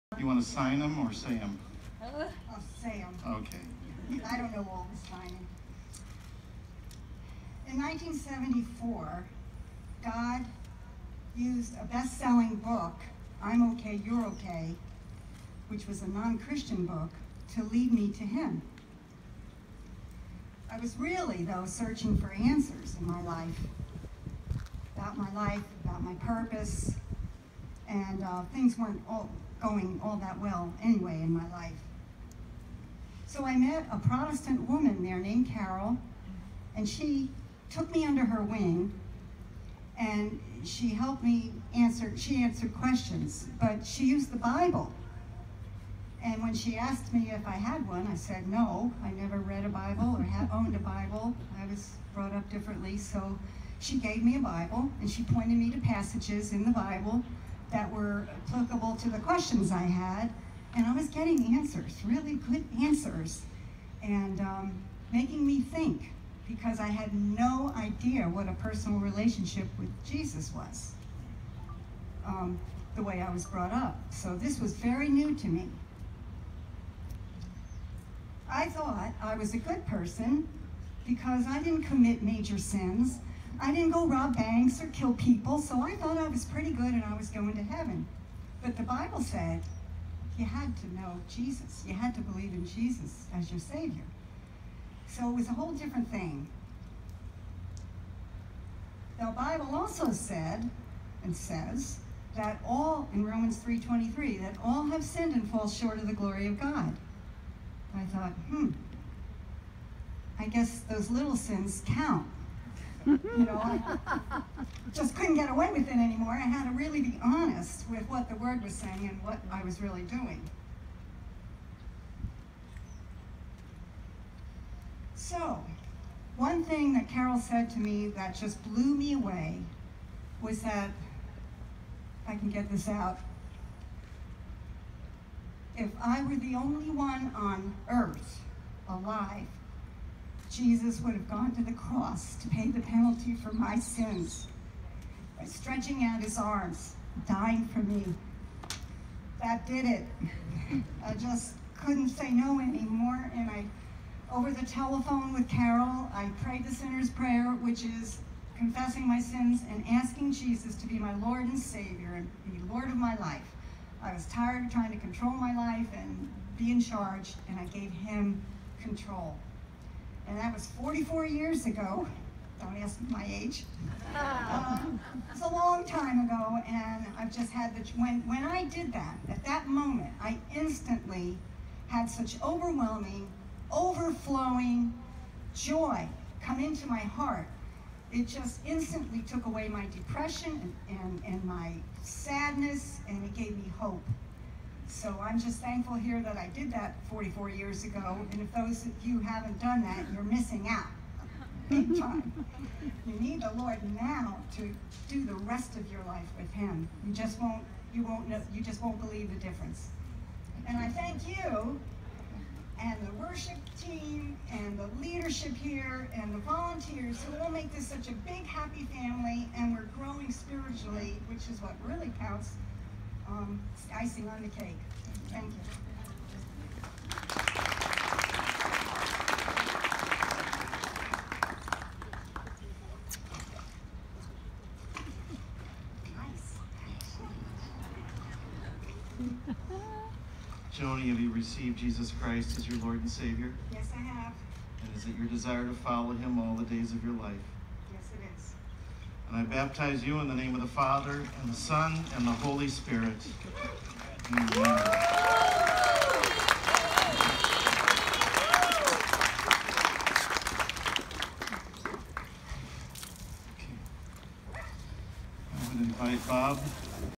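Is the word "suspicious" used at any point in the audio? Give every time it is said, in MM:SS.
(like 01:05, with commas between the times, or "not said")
not said.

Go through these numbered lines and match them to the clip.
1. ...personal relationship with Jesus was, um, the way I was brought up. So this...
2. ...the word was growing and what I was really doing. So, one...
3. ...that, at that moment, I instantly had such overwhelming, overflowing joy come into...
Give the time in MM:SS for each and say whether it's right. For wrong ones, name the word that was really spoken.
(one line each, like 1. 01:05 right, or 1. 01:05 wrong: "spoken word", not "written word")
1. 01:08 right
2. 01:58 wrong: "saying", not "growing"
3. 02:58 right.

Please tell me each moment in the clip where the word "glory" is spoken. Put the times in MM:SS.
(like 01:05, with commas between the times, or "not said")
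01:46.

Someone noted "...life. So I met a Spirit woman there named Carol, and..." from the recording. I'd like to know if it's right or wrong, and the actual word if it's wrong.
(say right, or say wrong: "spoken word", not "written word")
wrong: "Protestant", not "Spirit".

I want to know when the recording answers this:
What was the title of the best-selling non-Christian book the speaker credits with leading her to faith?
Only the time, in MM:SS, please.
00:13.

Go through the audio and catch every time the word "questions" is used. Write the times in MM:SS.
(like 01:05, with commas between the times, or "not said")
00:42, 00:59.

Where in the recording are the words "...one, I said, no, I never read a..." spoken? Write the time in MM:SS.
00:47.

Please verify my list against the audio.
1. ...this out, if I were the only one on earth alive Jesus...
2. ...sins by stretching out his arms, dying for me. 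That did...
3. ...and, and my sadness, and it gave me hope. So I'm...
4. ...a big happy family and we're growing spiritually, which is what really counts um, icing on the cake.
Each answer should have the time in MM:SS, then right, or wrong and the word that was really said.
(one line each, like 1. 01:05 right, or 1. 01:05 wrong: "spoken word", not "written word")
1. 02:12 right
2. 02:23 right
3. 03:10 right
4. 03:38 right.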